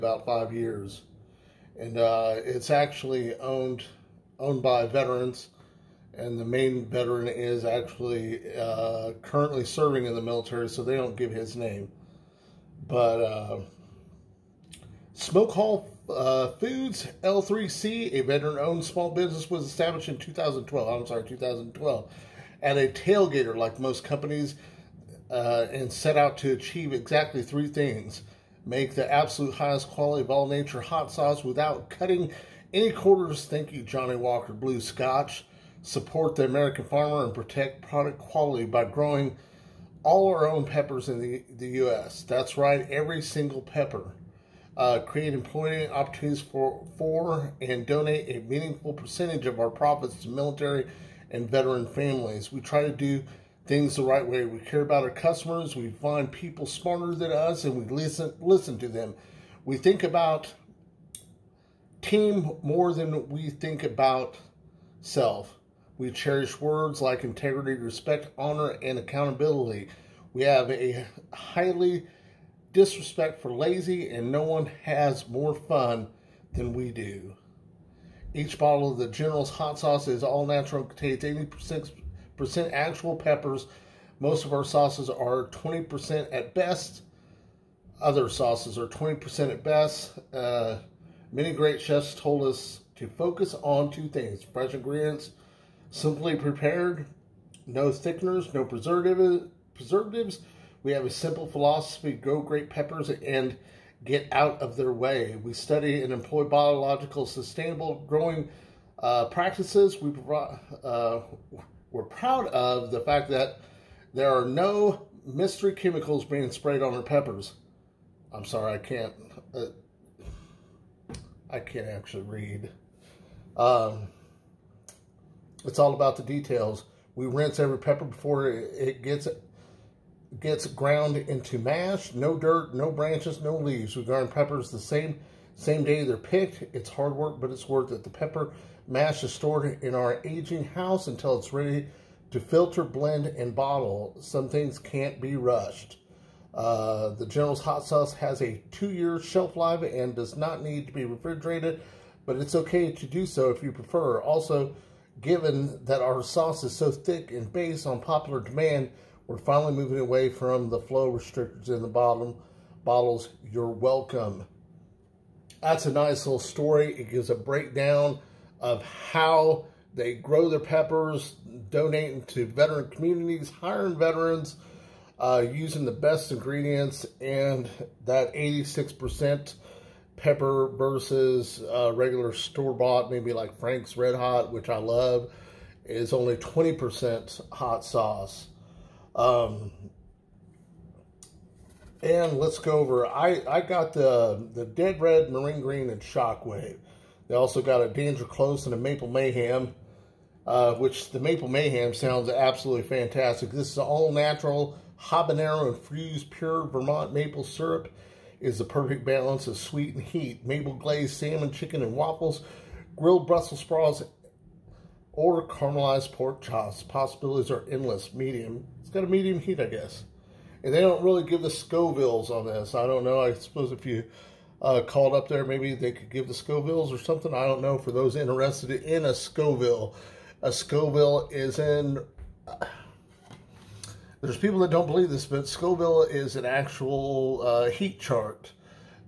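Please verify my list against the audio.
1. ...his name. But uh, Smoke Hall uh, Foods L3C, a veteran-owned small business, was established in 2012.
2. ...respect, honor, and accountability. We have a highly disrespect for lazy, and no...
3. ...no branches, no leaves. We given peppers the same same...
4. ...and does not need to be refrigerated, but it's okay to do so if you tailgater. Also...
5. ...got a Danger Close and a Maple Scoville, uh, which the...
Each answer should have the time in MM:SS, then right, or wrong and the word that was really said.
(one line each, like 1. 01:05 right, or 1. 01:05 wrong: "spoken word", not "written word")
1. 00:11 right
2. 01:07 right
3. 02:12 wrong: "garden", not "given"
4. 02:29 wrong: "prefer", not "tailgater"
5. 03:17 wrong: "Mayhem", not "Scoville".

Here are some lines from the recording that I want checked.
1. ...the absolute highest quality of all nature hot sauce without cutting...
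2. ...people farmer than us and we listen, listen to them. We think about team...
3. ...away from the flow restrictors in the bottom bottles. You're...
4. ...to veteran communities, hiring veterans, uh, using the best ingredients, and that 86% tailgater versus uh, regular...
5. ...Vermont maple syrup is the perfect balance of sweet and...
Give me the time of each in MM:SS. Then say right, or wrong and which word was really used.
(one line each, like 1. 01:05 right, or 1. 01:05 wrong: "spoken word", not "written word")
1. 00:28 right
2. 00:56 wrong: "smarter", not "farmer"
3. 02:39 right
4. 02:52 wrong: "pepper", not "tailgater"
5. 03:26 right.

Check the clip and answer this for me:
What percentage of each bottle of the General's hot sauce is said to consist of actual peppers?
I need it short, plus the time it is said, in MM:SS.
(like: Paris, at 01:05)
86%, at 01:21.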